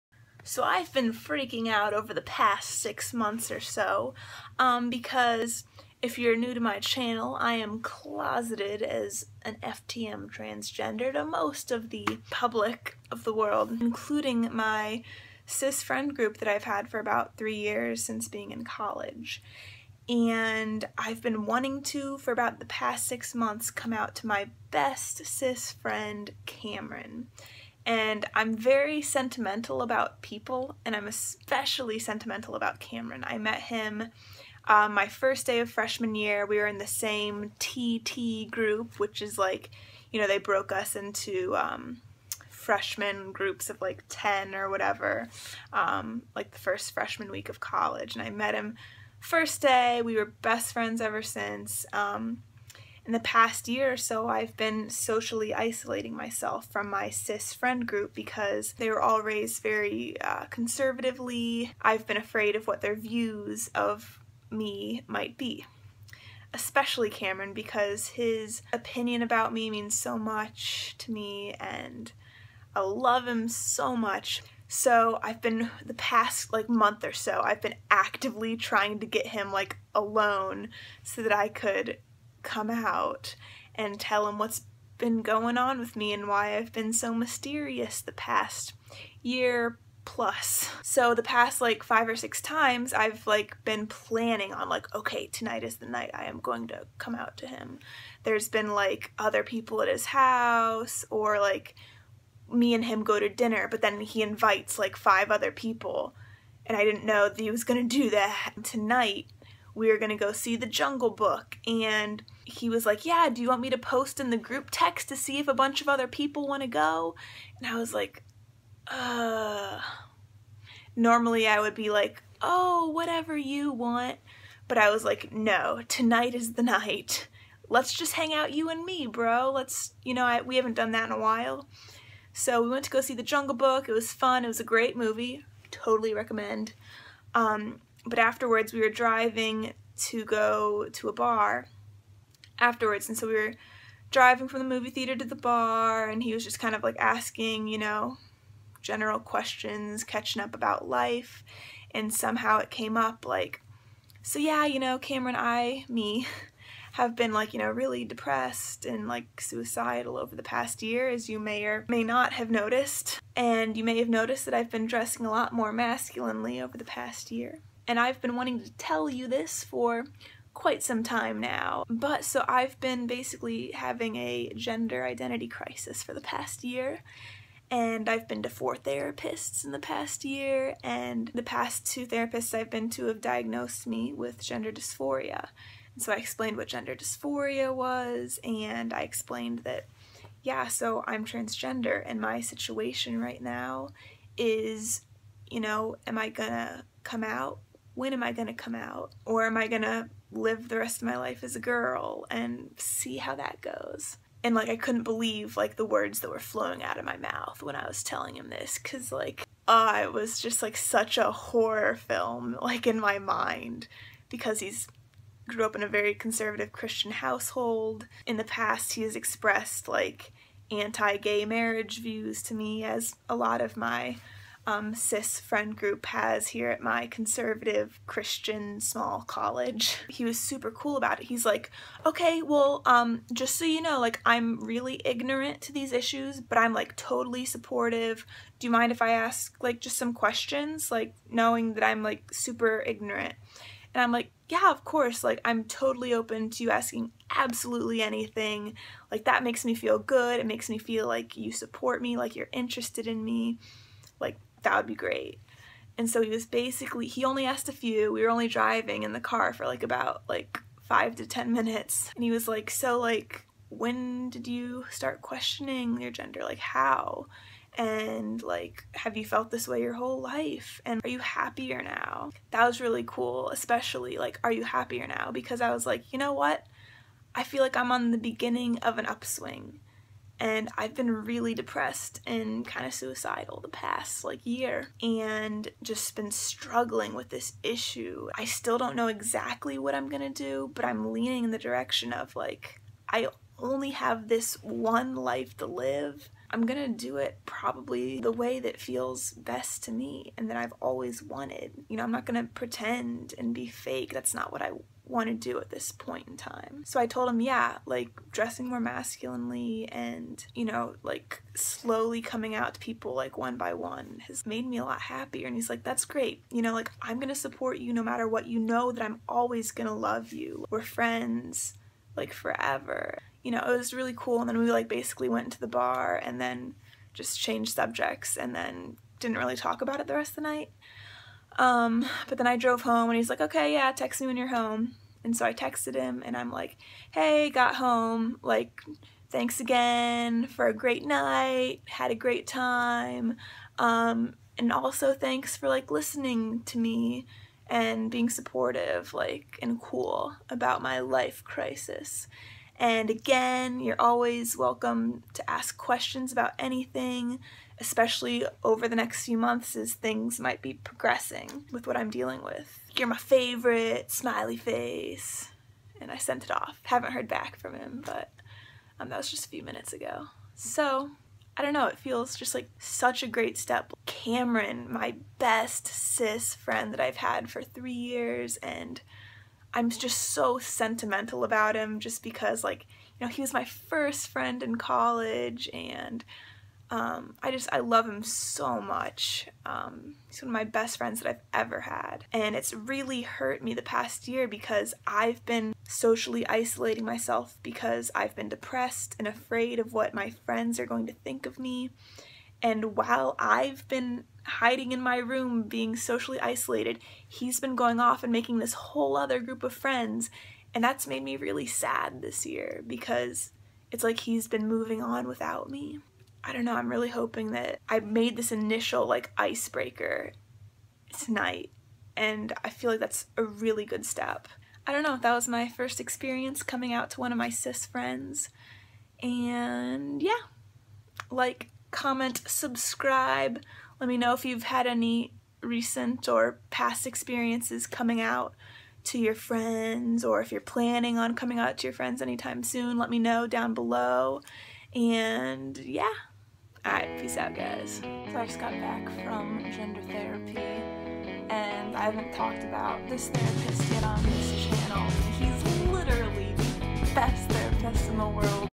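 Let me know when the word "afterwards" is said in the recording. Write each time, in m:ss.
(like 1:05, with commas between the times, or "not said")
2:18, 2:22.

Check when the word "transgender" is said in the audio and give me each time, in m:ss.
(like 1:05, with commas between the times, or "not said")
0:10, 3:11.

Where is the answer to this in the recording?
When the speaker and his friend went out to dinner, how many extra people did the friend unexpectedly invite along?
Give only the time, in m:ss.
1:44.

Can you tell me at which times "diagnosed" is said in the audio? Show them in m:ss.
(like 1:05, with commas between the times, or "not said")
3:03.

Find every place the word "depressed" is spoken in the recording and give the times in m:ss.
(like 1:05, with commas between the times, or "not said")
2:38, 4:41, 6:38.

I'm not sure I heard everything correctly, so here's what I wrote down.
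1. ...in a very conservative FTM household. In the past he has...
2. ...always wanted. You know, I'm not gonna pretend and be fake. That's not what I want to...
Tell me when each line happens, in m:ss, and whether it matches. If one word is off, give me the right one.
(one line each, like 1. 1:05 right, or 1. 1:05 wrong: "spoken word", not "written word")
1. 3:35 wrong: "Christian", not "FTM"
2. 5:00 right.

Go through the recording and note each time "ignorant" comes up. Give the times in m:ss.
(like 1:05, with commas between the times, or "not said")
3:55, 4:02.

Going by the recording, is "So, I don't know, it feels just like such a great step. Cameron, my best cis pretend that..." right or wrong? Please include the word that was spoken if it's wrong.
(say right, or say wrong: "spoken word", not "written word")
wrong: "friend", not "pretend".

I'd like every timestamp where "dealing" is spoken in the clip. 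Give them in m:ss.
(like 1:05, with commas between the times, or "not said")
6:02.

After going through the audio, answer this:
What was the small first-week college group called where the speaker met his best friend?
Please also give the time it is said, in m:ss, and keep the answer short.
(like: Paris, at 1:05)
TT group, at 0:37.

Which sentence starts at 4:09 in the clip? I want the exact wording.
Like that makes me feel good.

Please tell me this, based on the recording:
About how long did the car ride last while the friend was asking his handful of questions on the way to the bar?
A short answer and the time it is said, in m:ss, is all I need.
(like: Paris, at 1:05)
5 to 10 minutes, at 4:20.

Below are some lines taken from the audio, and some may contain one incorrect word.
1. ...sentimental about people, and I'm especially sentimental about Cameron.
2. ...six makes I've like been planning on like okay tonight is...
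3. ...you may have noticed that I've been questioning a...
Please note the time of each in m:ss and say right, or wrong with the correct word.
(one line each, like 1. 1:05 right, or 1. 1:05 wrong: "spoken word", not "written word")
1. 0:29 right
2. 1:32 wrong: "times", not "makes"
3. 2:43 wrong: "dressing", not "questioning".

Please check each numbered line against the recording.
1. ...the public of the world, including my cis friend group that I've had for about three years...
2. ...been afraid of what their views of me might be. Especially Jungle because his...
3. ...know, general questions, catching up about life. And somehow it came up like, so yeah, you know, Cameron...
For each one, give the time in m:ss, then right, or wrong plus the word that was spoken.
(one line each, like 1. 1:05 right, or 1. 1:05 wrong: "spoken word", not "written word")
1. 0:11 right
2. 1:02 wrong: "Cameron", not "Jungle"
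3. 2:27 right.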